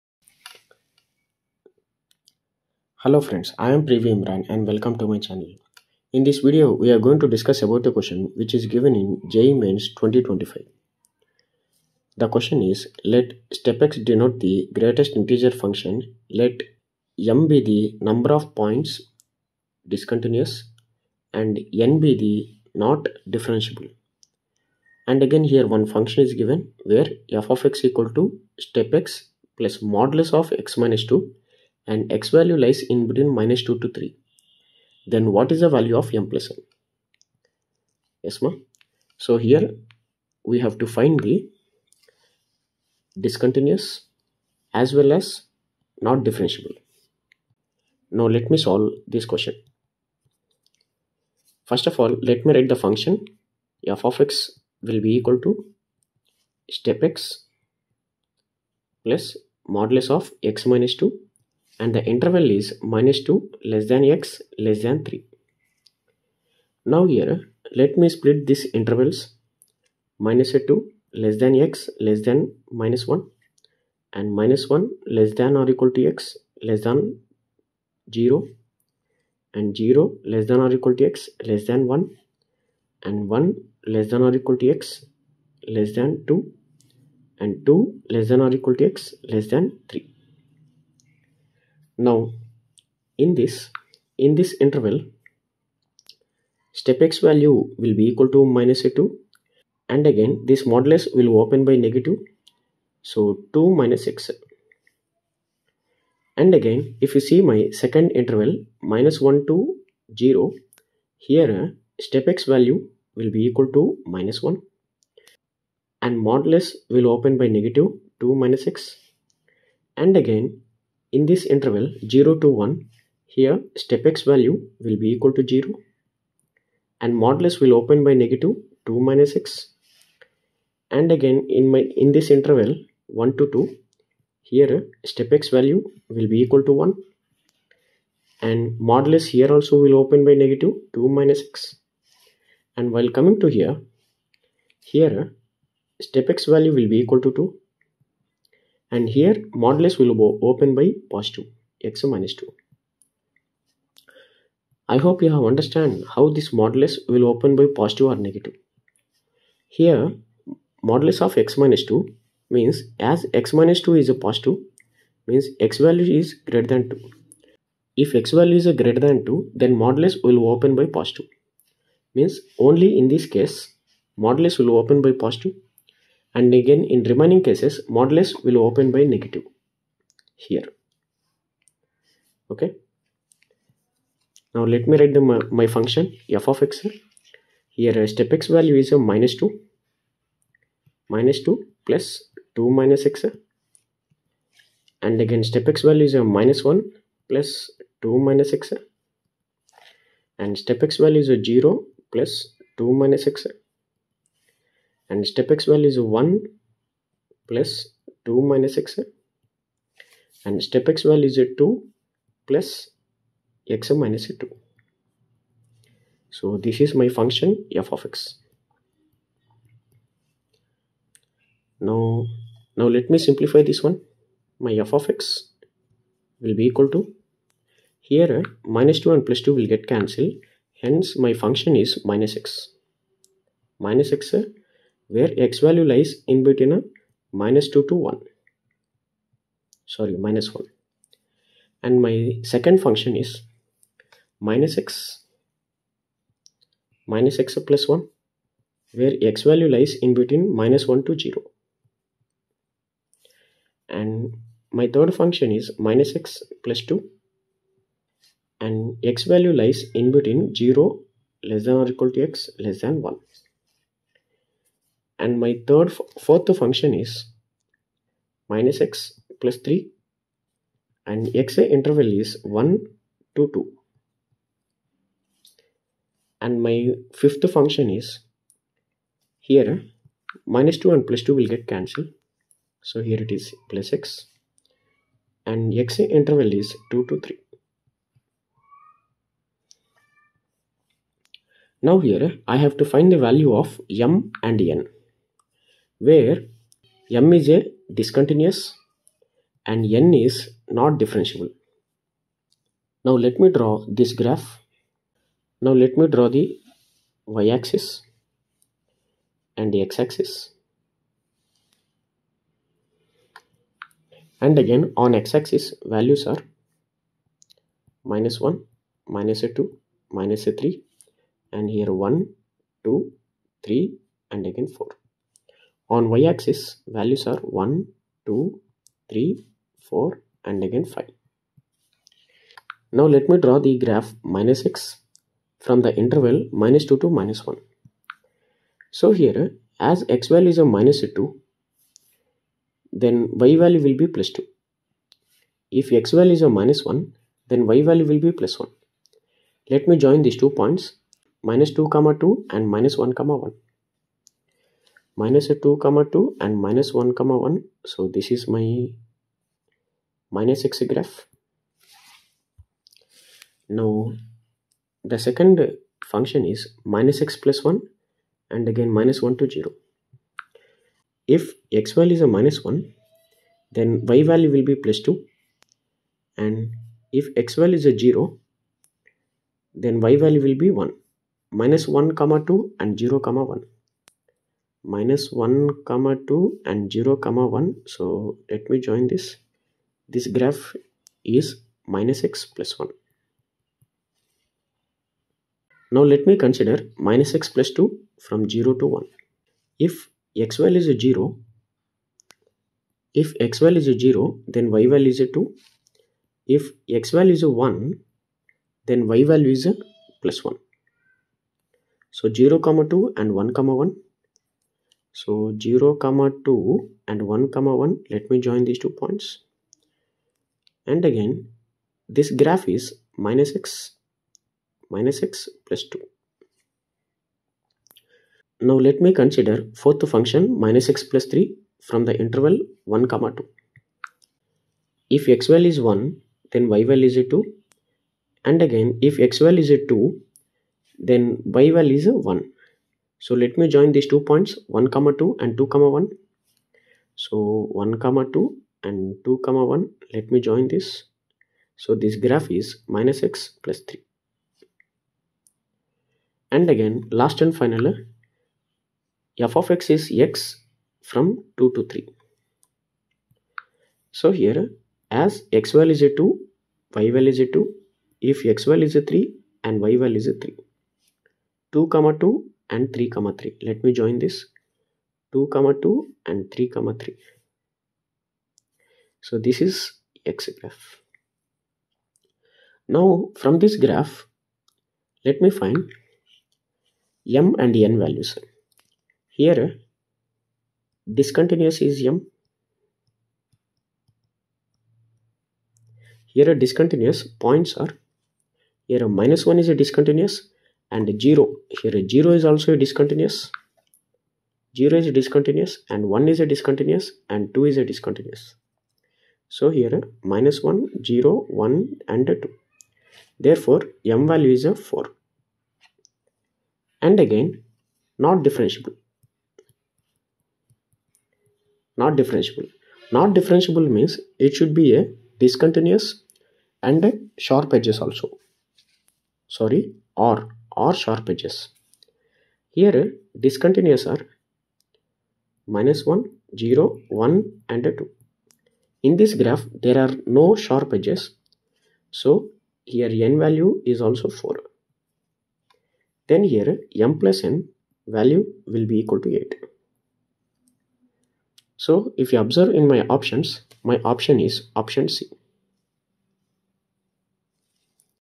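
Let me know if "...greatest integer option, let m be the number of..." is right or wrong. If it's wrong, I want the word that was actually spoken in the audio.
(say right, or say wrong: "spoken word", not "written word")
wrong: "function", not "option".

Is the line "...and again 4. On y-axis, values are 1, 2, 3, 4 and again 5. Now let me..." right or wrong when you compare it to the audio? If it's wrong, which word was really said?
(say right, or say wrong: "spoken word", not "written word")
right.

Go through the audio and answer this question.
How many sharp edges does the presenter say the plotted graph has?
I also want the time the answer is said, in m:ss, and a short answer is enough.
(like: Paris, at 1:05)
0, at 8:59.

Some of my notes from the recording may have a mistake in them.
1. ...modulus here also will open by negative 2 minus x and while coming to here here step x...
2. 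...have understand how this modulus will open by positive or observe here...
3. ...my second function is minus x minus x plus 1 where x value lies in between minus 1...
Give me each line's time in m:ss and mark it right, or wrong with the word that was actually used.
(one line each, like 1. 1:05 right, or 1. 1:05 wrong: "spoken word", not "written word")
1. 2:18 right
2. 2:35 wrong: "negative", not "observe"
3. 4:02 right.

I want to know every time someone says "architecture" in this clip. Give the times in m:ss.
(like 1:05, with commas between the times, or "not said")
not said.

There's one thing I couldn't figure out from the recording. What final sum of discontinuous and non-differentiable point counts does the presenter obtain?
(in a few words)
8.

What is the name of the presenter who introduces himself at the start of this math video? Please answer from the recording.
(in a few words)
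Privy Imran.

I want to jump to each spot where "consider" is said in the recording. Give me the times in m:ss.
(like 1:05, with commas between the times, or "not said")
6:36, 7:09.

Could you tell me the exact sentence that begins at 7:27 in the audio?
So 1 comma 2 and 2 comma 1 let me join this.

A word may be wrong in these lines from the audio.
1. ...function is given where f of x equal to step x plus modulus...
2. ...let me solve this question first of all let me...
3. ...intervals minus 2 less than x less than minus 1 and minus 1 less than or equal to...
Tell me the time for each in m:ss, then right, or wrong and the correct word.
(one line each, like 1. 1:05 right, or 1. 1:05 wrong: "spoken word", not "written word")
1. 0:25 right
2. 0:48 right
3. 1:08 right.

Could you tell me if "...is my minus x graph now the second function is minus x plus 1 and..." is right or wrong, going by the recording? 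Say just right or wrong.
right.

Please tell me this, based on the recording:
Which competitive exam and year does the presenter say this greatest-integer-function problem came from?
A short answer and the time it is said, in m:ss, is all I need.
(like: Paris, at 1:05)
JEE Mains 2025, at 0:09.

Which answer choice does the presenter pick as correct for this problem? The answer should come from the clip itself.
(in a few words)
Option C.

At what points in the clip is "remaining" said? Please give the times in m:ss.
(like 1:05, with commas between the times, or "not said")
2:57.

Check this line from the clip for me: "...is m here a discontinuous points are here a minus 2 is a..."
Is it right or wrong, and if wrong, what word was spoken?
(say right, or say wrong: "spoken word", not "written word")
wrong: "1", not "2".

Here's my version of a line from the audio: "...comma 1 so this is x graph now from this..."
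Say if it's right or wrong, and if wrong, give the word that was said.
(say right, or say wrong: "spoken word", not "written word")
wrong: "3", not "1".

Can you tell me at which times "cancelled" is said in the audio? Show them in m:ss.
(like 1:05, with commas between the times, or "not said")
3:49, 4:41.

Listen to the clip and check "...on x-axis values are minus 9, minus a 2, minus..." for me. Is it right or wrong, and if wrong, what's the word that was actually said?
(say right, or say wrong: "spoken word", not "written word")
wrong: "1", not "9".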